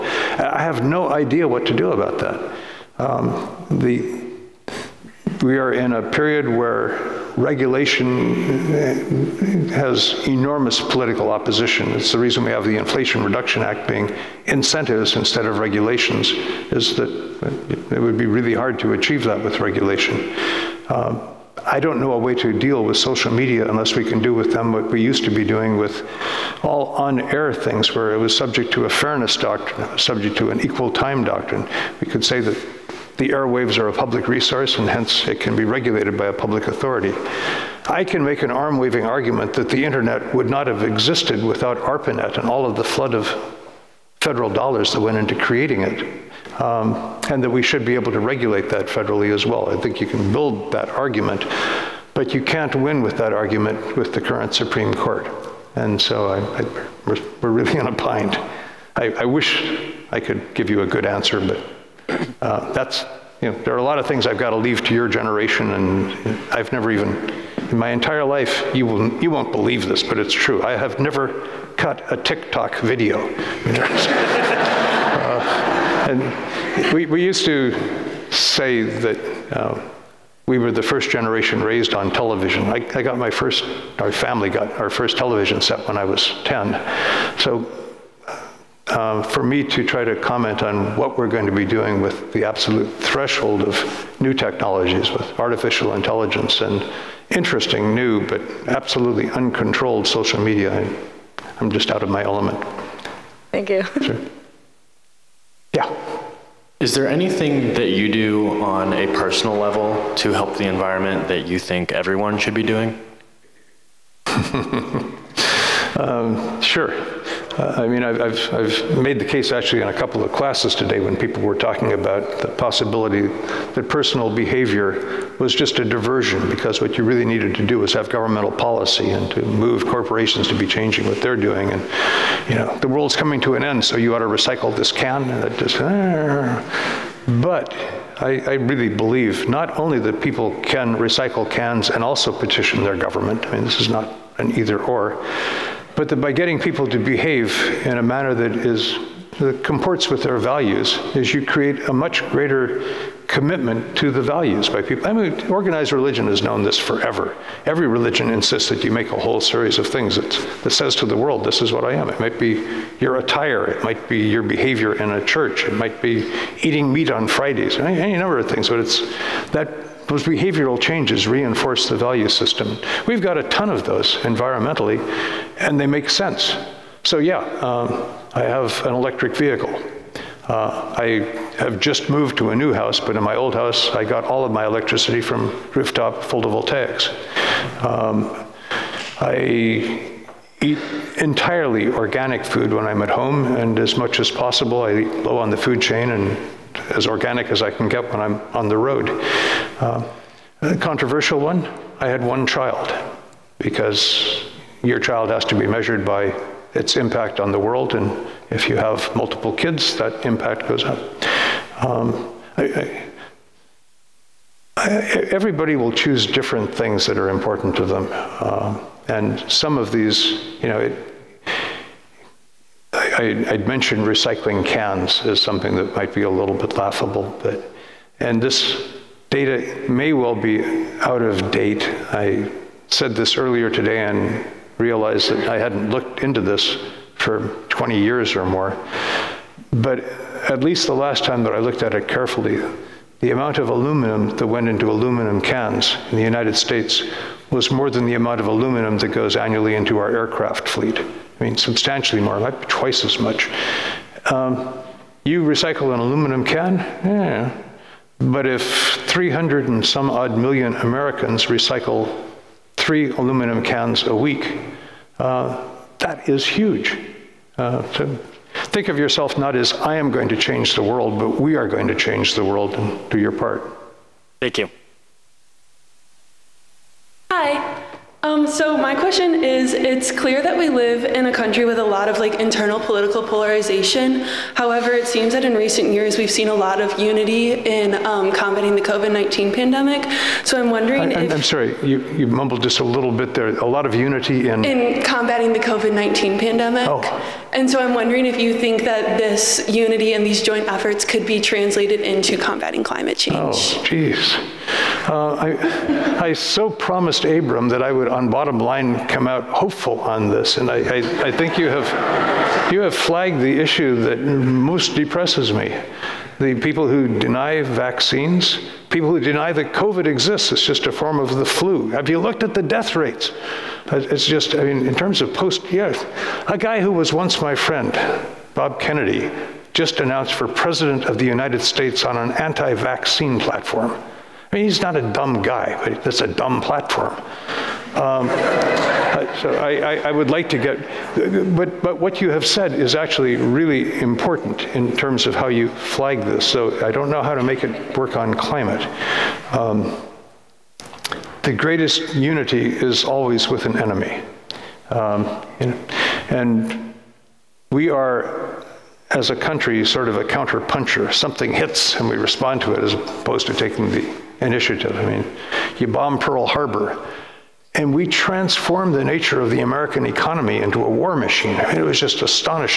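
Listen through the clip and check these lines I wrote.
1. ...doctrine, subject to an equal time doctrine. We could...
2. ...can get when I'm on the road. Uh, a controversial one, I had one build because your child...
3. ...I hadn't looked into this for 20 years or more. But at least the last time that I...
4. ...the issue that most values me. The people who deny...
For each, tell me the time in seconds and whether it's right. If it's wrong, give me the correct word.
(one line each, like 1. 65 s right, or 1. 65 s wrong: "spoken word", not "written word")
1. 29 s right
2. 197 s wrong: "child", not "build"
3. 235 s right
4. 313 s wrong: "depresses", not "values".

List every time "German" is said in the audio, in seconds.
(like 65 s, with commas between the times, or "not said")
not said.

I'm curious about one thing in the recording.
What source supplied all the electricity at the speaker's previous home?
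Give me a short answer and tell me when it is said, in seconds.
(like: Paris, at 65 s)
Rooftop photovoltaics, at 185 s.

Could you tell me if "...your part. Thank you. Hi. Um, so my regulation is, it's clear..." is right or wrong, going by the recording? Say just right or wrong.
wrong.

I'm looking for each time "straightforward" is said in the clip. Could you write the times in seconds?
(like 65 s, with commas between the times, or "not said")
not said.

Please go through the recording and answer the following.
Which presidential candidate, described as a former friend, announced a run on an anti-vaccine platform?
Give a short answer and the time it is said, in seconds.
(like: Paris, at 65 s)
Bob Kennedy, at 328 s.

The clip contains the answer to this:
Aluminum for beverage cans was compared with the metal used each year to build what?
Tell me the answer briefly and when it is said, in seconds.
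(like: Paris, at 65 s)
Aircraft fleet, at 250 s.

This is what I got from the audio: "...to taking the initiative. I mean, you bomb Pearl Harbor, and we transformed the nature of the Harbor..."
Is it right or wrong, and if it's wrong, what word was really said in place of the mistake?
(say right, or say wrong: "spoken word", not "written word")
wrong: "American", not "Harbor".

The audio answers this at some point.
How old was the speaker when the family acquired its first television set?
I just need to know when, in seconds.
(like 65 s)
86 s.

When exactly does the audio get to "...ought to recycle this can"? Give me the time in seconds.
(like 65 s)
134 s.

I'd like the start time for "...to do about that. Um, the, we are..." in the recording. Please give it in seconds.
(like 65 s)
1 s.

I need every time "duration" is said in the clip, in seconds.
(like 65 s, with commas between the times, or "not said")
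not said.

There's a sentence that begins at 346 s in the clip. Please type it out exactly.
So I don't know how to make it work on climate.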